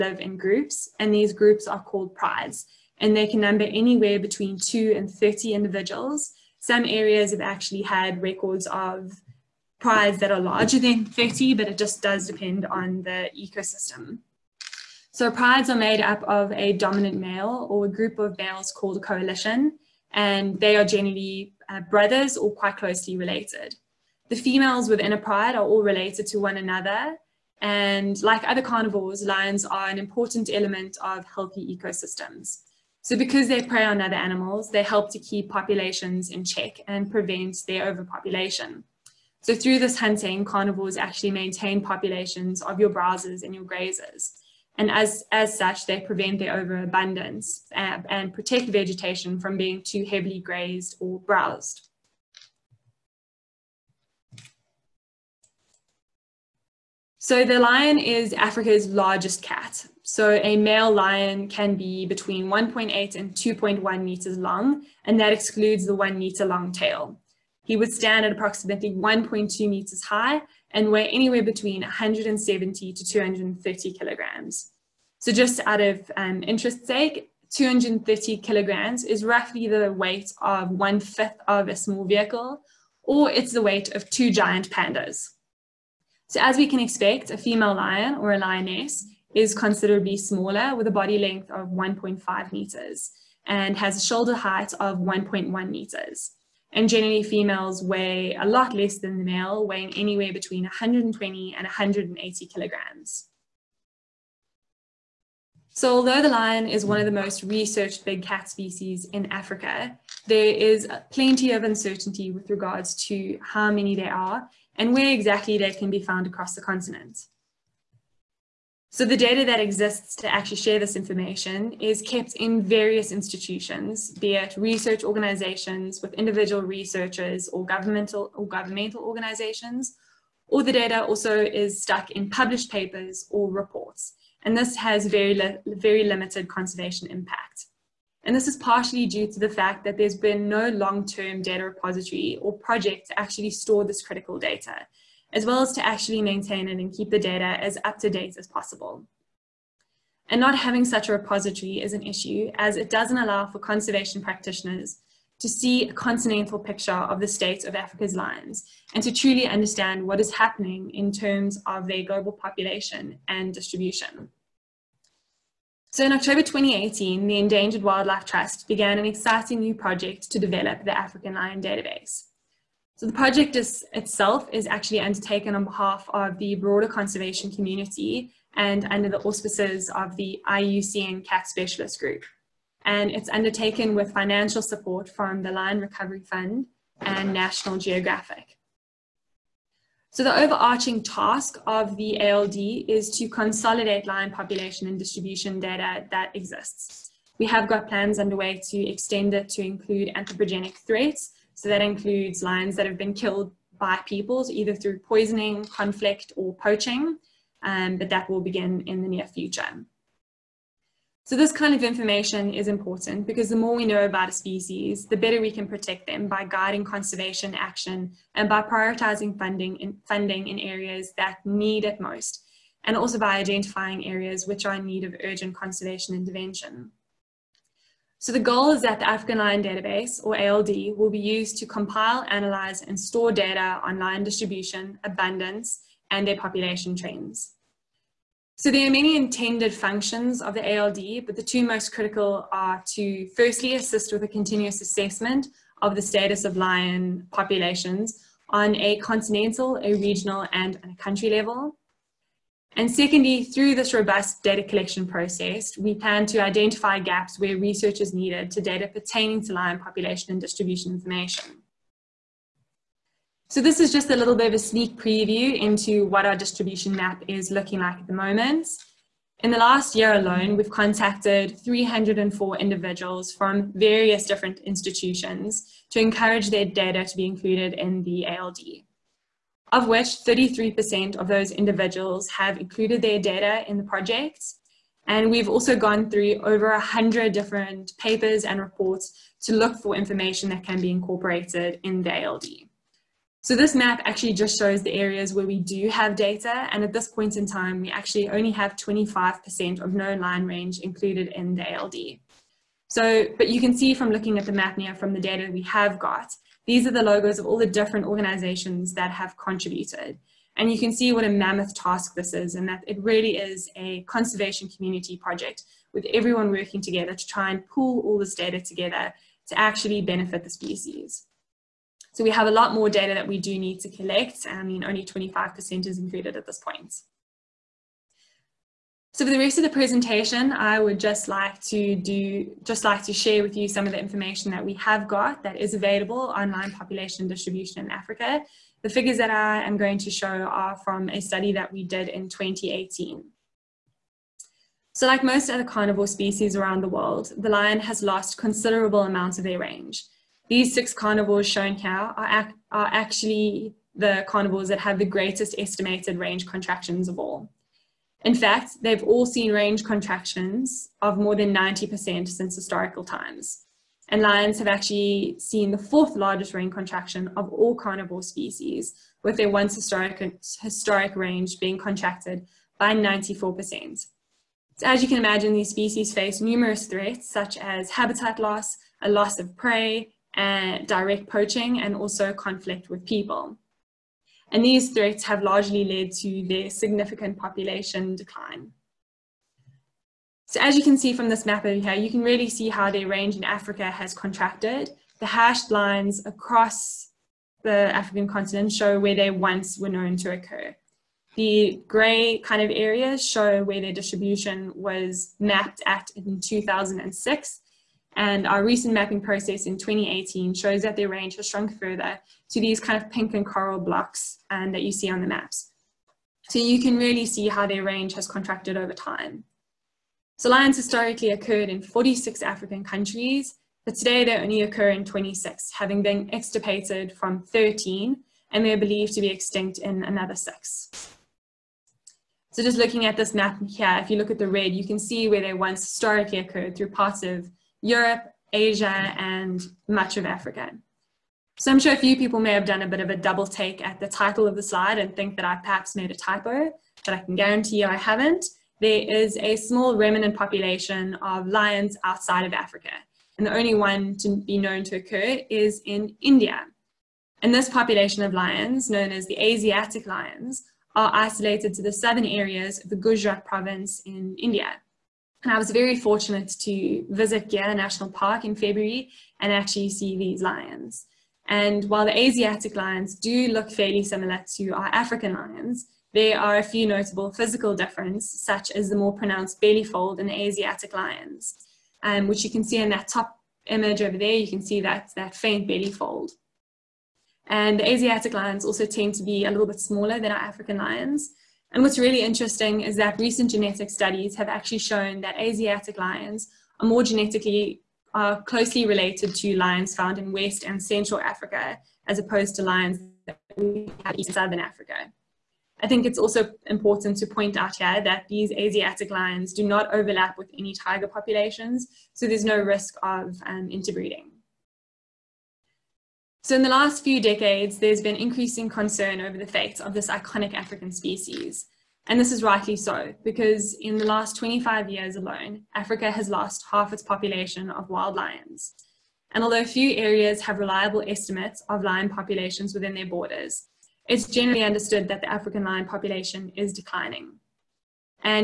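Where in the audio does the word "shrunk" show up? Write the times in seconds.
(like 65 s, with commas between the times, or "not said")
411 s.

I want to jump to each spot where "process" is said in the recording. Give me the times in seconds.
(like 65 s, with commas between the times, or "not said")
255 s, 409 s.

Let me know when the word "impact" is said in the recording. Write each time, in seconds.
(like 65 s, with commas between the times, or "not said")
137 s.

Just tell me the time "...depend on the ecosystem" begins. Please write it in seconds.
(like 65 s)
12 s.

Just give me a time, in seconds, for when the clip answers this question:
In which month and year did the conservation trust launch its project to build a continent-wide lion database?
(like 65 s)
166 s.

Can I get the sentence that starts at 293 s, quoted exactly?
So this map actually just shows the areas where we do have data.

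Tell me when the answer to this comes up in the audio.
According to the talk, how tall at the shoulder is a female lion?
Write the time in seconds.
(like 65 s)
94 s.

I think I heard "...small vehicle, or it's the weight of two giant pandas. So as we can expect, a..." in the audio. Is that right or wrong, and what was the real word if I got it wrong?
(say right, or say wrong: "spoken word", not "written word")
right.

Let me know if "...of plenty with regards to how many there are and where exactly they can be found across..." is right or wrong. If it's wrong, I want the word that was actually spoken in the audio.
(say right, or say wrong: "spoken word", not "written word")
wrong: "uncertainty", not "plenty".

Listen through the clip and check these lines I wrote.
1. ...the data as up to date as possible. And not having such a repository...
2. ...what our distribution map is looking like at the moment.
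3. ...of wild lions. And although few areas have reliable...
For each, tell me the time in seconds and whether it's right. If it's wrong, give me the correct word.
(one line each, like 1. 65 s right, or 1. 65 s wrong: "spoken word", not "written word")
1. 147 s right
2. 266 s right
3. 527 s right.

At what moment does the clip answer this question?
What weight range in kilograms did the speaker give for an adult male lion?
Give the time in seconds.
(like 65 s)
71 s.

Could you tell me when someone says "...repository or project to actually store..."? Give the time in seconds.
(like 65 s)
141 s.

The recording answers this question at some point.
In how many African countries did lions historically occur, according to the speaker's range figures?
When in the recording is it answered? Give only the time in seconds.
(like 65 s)
421 s.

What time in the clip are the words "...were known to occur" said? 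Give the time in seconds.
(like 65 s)
399 s.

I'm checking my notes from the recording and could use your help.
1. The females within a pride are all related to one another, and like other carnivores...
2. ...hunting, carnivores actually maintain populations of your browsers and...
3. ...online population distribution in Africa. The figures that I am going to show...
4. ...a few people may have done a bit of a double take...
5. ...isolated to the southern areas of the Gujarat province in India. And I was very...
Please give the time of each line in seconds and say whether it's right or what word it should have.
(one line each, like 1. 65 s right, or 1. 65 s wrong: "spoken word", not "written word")
1. 24 s right
2. 39 s right
3. 336 s right
4. 441 s right
5. 461 s right.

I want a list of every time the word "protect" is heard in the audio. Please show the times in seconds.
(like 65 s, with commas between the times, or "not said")
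48 s, 215 s.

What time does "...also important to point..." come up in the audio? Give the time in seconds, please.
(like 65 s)
506 s.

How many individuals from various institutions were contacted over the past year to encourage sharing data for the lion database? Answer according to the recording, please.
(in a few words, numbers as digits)
304.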